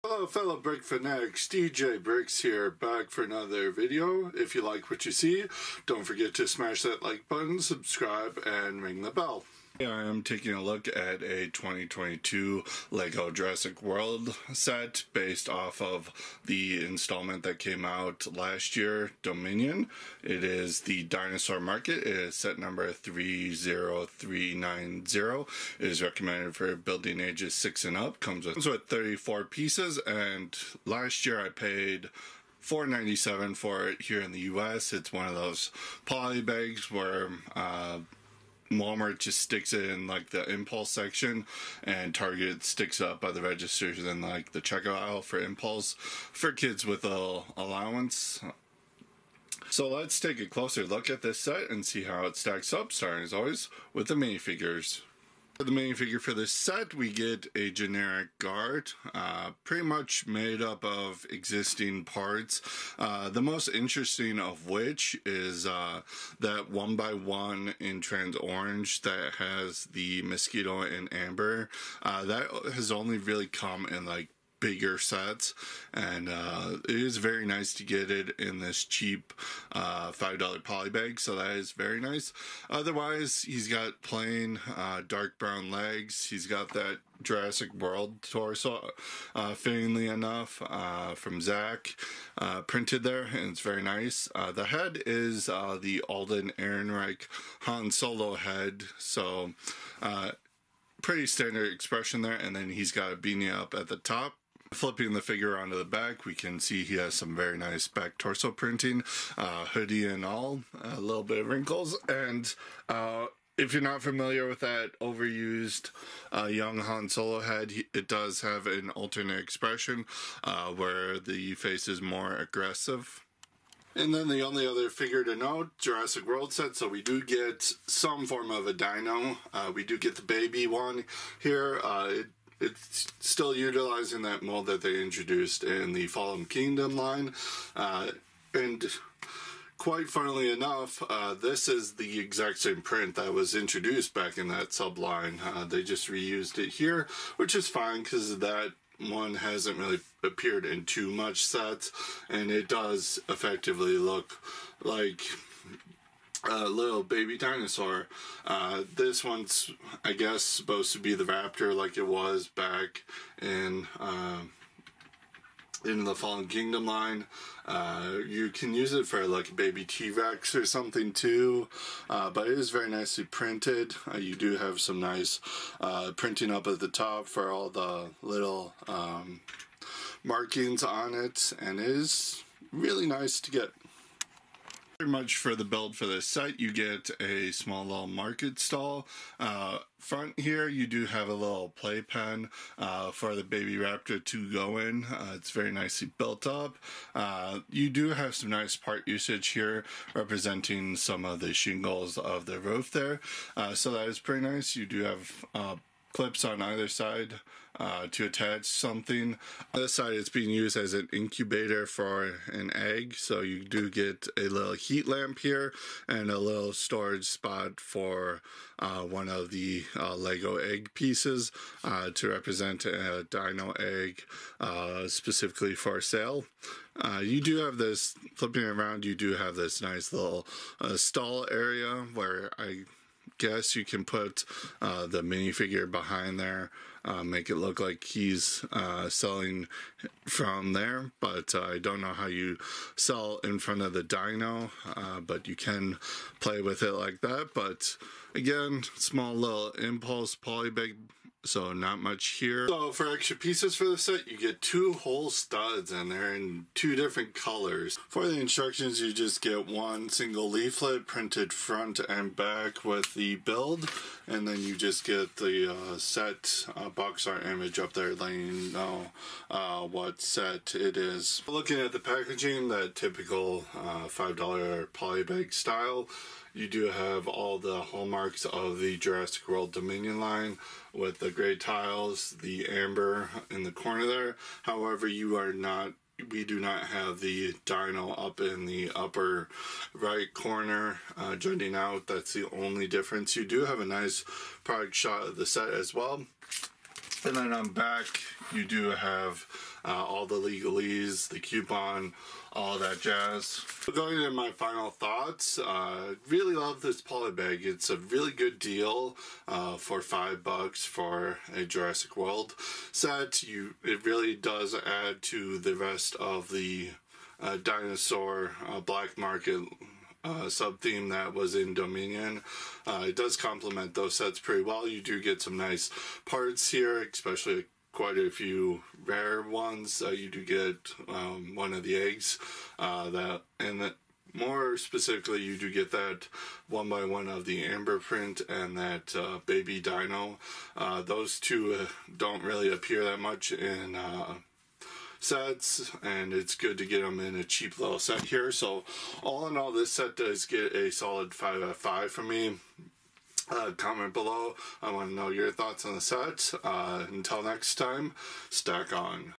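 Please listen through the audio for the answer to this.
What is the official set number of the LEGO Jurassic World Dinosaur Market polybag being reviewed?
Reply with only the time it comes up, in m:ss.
0:22.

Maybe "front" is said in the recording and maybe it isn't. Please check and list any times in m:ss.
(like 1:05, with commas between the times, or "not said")
3:09, 4:03, 4:21.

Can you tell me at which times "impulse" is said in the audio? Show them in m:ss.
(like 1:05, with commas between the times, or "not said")
0:40, 0:45, 4:09.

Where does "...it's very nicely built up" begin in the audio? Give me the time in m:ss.
3:15.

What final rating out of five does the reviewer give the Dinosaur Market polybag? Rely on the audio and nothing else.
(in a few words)
5 out of 5.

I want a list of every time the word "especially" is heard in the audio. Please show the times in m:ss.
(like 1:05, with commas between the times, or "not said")
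5:27.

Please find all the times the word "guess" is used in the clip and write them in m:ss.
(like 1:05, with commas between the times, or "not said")
2:40, 3:53.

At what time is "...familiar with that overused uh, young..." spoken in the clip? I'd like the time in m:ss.
1:54.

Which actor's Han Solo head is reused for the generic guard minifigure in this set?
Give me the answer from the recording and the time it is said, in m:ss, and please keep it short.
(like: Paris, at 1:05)
Alden Ehrenreich, at 1:36.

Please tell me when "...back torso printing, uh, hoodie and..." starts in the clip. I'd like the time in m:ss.
1:47.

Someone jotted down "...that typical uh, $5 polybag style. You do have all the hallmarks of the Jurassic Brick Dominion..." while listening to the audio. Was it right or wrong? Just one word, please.
wrong.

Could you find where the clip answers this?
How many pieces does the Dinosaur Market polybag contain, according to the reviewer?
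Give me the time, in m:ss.
0:28.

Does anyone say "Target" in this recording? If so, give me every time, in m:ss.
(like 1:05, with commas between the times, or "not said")
0:42.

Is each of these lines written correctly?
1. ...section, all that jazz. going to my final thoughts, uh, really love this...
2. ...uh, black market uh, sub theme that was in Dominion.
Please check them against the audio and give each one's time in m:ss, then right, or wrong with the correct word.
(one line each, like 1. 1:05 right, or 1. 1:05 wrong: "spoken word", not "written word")
1. 5:01 wrong: "coupon", not "section"
2. 5:18 right.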